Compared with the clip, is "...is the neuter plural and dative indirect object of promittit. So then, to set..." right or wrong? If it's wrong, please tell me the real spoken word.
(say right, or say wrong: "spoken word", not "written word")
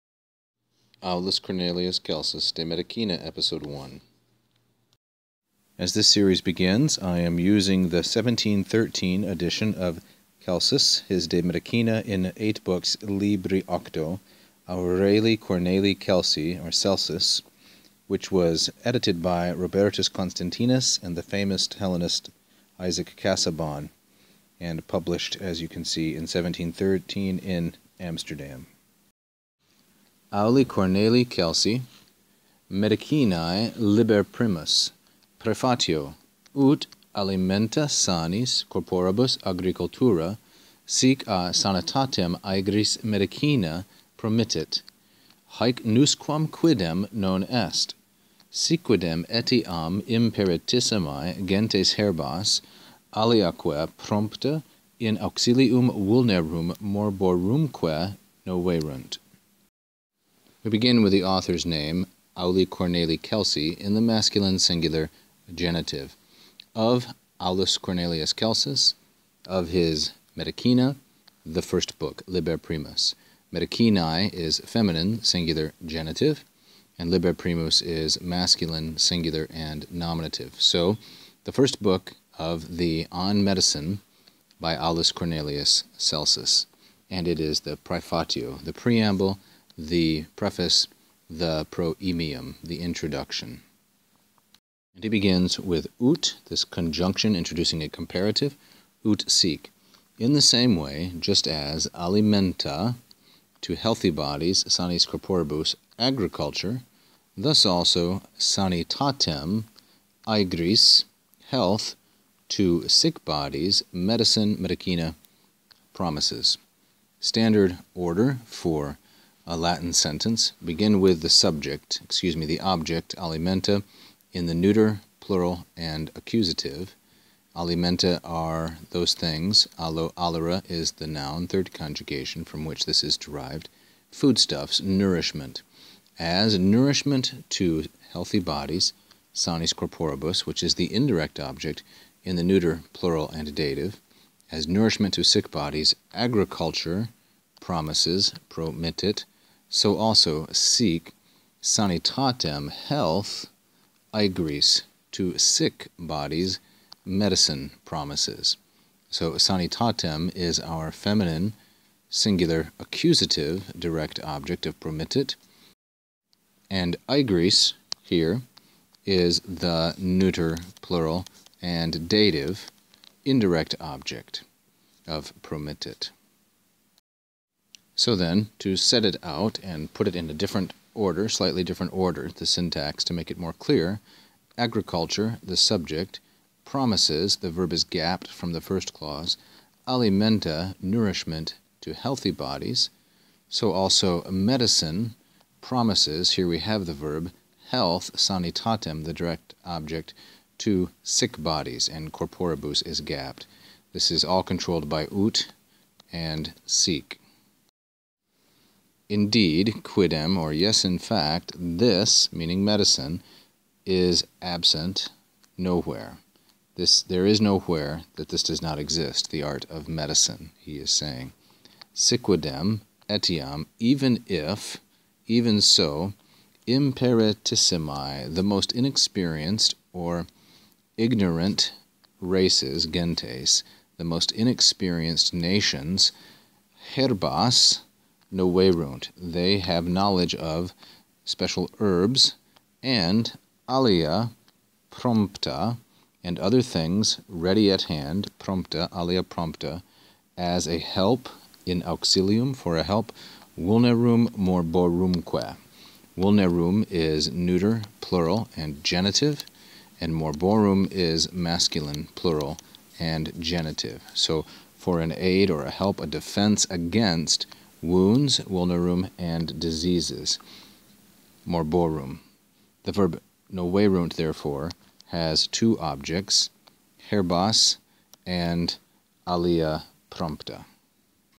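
right.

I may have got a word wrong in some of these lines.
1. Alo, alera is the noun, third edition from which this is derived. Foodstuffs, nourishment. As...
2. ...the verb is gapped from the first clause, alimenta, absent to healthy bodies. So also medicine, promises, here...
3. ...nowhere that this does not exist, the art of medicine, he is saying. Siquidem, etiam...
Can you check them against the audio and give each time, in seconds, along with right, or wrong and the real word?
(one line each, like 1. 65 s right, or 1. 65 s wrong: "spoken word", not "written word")
1. 129 s wrong: "conjugation", not "edition"
2. 187 s wrong: "nourishment", not "absent"
3. 217 s right.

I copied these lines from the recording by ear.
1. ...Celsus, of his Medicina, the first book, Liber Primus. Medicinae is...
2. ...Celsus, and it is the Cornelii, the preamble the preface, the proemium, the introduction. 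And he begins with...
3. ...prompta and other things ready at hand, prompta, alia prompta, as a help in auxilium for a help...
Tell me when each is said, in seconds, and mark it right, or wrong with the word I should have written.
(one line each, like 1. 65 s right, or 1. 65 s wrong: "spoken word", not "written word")
1. 68 s right
2. 85 s wrong: "Praefatio", not "Cornelii"
3. 244 s right.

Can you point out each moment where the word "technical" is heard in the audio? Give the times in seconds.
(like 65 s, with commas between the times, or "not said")
not said.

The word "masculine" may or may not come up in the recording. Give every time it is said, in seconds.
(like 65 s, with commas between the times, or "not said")
64 s, 78 s, 261 s.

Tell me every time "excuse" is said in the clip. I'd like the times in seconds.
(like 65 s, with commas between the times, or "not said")
122 s.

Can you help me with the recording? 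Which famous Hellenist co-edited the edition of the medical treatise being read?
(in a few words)
Isaac Casaubon.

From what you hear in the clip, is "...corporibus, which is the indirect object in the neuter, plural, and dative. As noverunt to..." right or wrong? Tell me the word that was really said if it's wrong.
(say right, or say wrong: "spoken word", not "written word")
wrong: "nourishment", not "noverunt".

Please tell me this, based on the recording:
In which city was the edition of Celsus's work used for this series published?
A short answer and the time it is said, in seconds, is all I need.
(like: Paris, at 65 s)
Amsterdam, at 27 s.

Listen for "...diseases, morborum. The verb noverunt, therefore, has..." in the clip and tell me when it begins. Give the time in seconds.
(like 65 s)
269 s.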